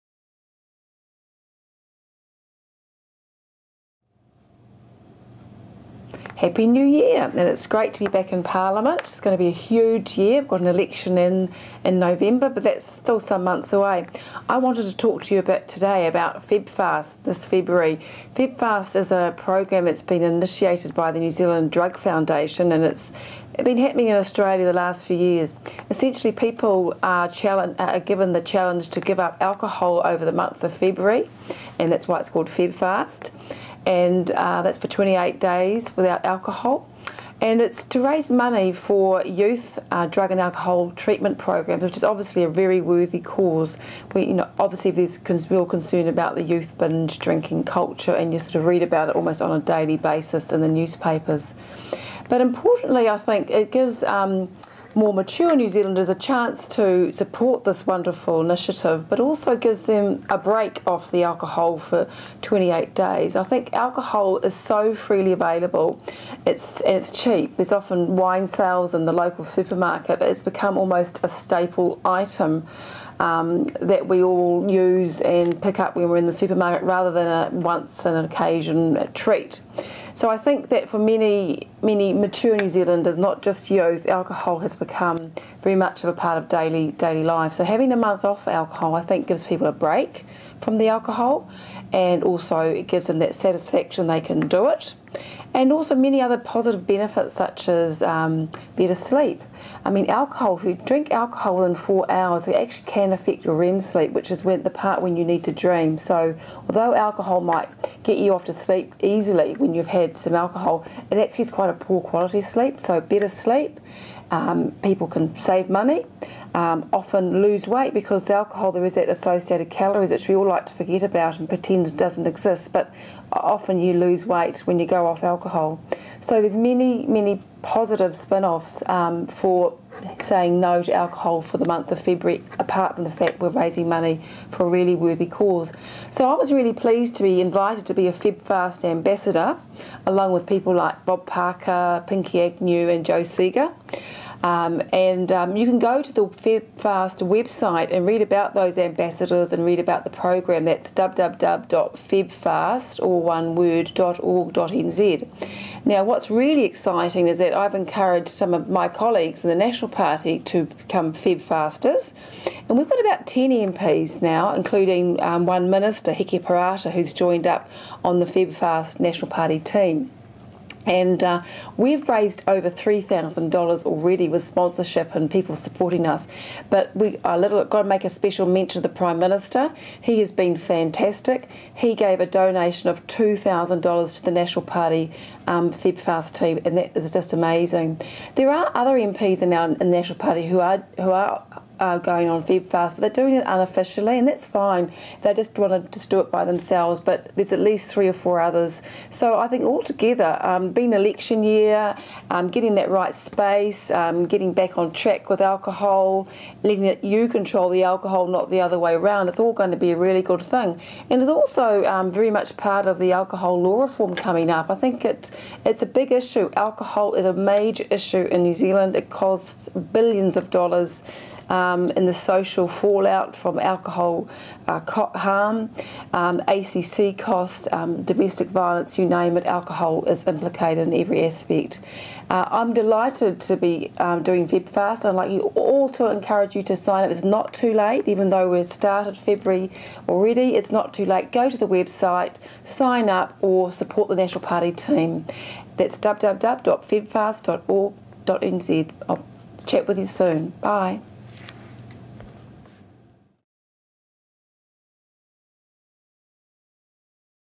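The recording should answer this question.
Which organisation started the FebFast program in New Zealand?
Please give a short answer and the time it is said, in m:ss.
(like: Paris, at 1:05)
New Zealand Drug Foundation, at 0:21.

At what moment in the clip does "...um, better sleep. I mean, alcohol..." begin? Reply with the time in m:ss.
1:38.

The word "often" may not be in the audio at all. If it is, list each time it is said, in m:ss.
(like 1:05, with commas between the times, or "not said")
1:07, 1:56, 2:03.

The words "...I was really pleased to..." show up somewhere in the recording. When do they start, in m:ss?
2:16.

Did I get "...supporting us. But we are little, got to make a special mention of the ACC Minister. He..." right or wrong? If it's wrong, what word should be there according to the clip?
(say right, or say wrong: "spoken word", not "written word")
wrong: "Prime", not "ACC".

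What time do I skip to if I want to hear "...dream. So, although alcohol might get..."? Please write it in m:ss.
1:45.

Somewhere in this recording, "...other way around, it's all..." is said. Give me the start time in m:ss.
3:28.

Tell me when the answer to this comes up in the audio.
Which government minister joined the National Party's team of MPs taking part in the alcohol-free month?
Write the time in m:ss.
2:46.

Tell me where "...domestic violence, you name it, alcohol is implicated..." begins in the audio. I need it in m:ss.
3:48.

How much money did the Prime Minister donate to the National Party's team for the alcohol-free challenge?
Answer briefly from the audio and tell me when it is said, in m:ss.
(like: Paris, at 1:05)
$2,000, at 3:03.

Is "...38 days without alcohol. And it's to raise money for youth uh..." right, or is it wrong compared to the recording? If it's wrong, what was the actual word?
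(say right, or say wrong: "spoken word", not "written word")
wrong: "28", not "38".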